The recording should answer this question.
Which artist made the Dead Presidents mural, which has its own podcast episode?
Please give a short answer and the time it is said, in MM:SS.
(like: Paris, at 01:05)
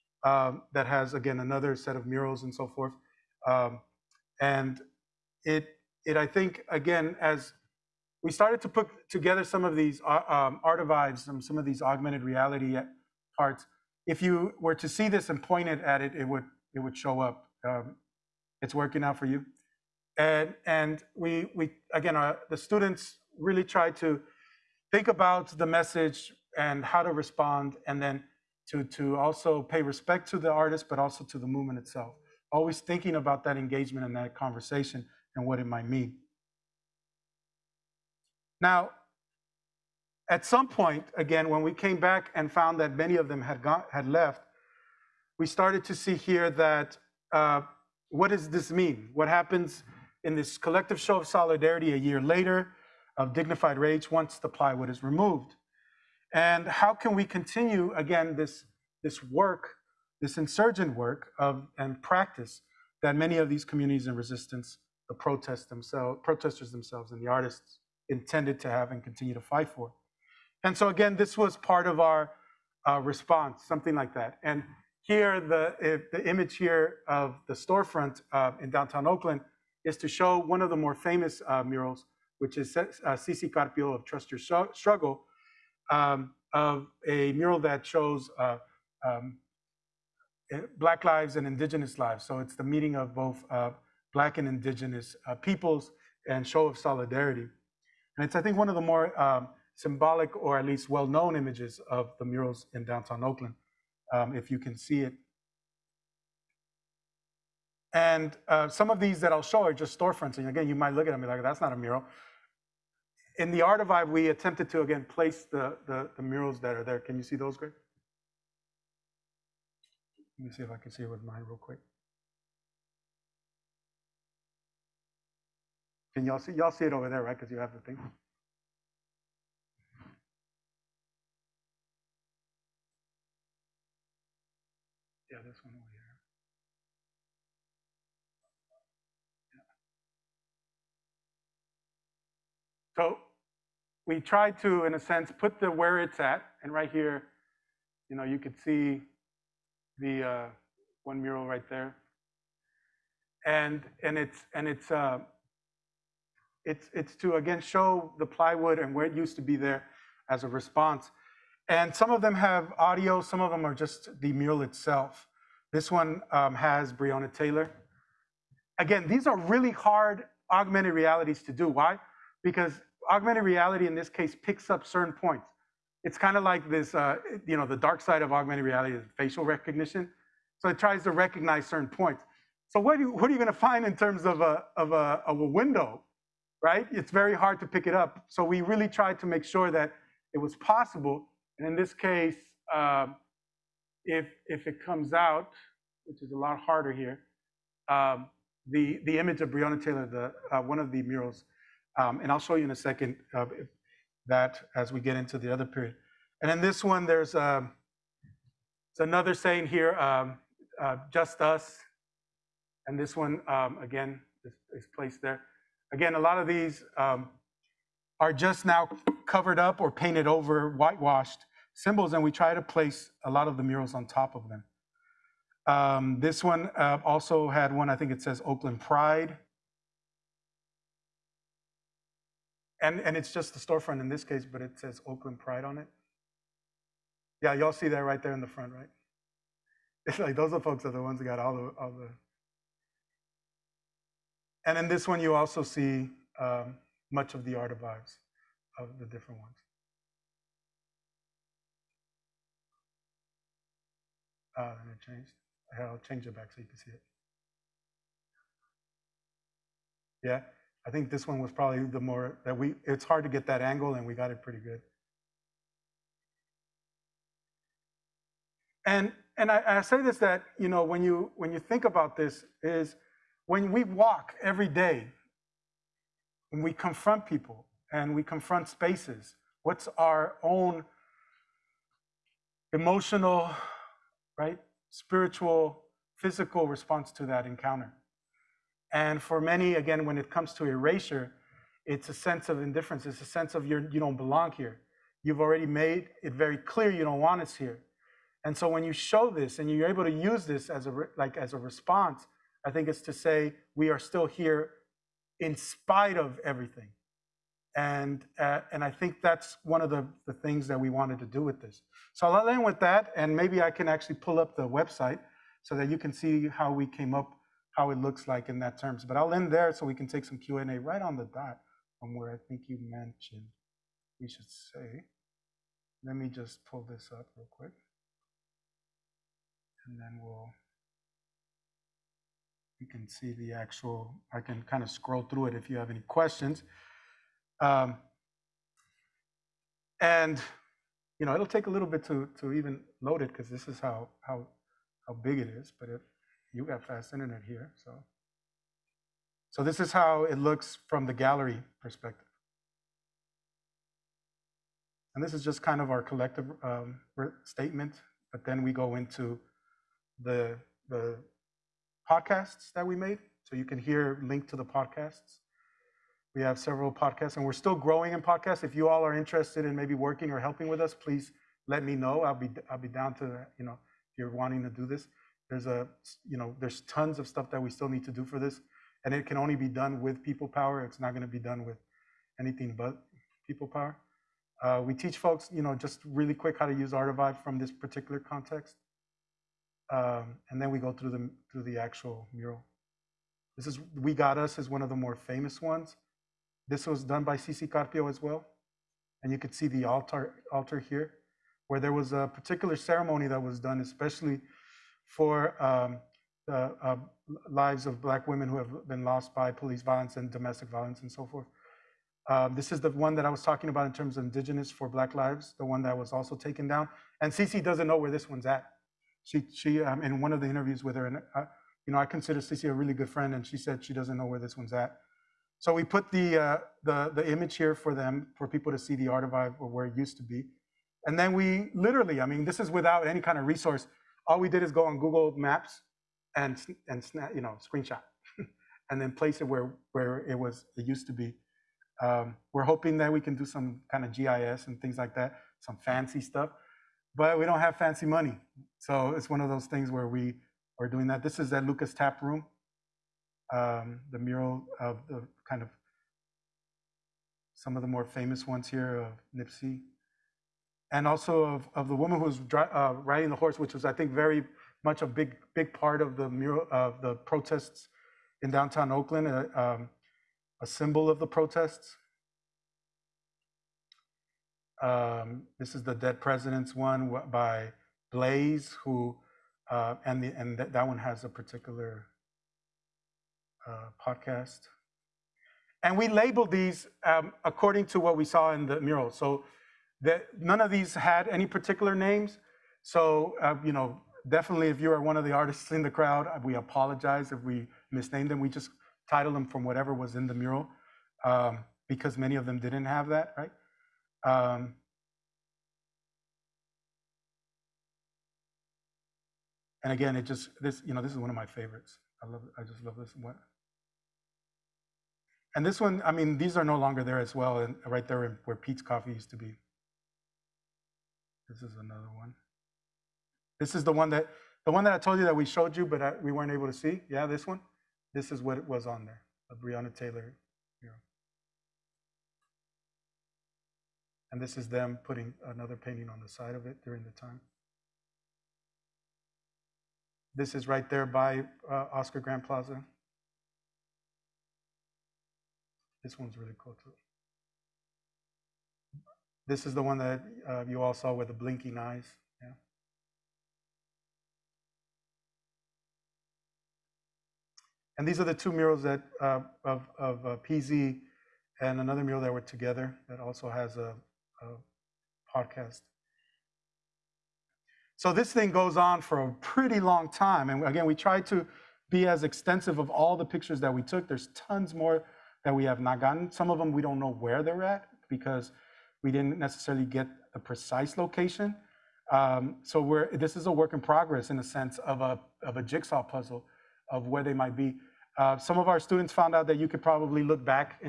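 Blaze, at 07:58.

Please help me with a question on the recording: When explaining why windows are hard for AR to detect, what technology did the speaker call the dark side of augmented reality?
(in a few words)
facial recognition.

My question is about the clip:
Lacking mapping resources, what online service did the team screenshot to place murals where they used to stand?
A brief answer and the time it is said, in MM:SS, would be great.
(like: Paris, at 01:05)
Google Maps, at 07:14.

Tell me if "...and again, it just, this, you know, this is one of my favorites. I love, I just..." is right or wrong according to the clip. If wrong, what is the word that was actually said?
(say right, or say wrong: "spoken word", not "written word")
right.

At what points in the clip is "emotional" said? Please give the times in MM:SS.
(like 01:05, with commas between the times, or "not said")
04:42.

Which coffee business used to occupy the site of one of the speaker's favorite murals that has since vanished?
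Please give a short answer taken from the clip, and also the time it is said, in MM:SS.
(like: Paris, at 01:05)
Peet's Coffee, at 08:38.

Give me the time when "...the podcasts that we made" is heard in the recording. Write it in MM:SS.
06:00.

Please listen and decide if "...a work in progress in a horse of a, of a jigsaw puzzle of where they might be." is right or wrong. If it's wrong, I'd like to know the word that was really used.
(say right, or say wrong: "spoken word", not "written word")
wrong: "sense", not "horse".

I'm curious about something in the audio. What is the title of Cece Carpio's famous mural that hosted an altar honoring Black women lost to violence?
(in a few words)
We Got Us.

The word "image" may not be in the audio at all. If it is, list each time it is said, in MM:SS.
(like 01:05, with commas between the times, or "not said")
01:16, 01:41, 03:19, 07:07.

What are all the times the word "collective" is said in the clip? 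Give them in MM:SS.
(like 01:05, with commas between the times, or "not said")
00:50, 05:56.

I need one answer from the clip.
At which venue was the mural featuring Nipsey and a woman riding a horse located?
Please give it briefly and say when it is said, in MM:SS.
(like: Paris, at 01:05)
Lukas Tap Room, at 07:31.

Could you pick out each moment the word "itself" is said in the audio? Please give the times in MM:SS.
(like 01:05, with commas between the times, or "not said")
00:31, 02:44.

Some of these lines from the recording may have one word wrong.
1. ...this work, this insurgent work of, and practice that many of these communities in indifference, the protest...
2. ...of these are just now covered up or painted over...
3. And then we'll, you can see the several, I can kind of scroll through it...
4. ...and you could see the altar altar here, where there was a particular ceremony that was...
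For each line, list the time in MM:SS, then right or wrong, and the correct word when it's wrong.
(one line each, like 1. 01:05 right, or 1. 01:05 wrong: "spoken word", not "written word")
1. 00:59 wrong: "resistance", not "indifference"
2. 03:36 right
3. 05:29 wrong: "actual", not "several"
4. 06:39 right.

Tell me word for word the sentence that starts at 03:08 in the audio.
So we really tried to make sure that it was possible.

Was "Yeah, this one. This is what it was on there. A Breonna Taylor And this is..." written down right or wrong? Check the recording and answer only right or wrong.
right.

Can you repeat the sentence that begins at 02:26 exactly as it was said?
And right here, you know, you could see the uh, one mural right there.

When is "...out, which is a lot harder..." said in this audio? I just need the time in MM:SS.
03:15.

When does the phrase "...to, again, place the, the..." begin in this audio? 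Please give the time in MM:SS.
01:54.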